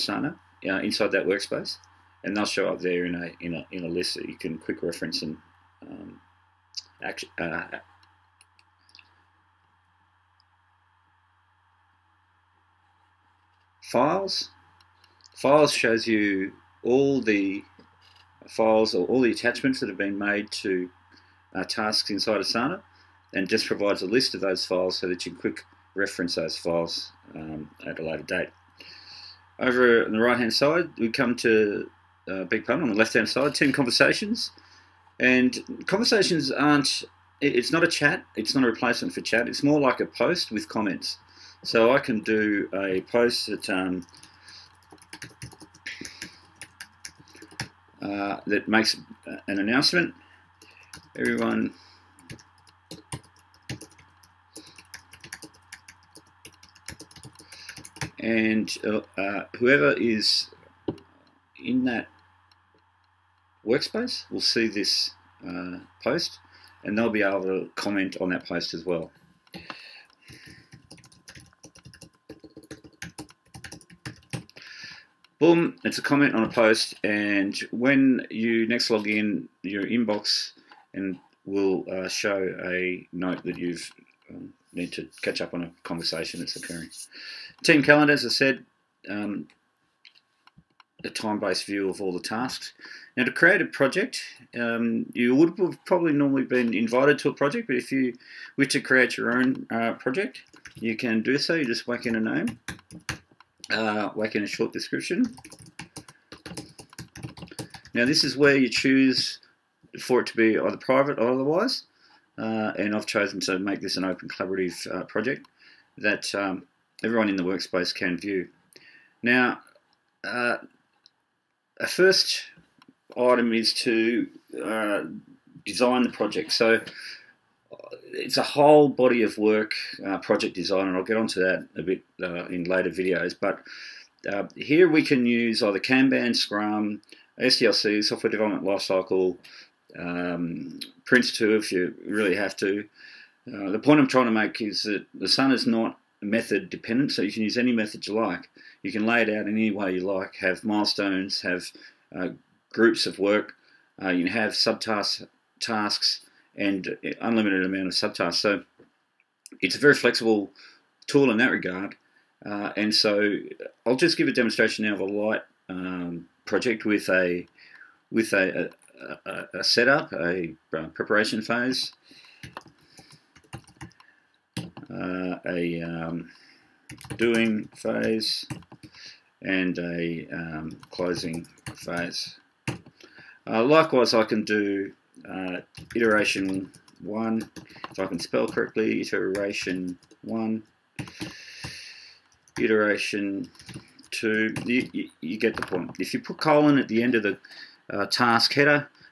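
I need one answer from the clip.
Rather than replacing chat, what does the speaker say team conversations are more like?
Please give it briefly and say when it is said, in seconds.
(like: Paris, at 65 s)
A post with comments, at 39 s.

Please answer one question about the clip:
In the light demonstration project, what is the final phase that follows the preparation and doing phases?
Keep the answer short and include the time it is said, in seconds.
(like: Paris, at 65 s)
Closing phase, at 180 s.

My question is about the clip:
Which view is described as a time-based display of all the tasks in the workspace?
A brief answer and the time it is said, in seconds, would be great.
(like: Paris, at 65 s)
Team calendar, at 87 s.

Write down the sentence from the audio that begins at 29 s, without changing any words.
Over on the right hand side, we come to uh, Big Pun on the left hand side, team conversations.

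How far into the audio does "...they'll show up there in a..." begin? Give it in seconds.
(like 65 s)
2 s.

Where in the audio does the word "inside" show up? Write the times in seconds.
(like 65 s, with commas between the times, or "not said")
0 s, 22 s.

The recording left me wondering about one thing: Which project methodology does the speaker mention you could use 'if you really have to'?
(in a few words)
Prince2.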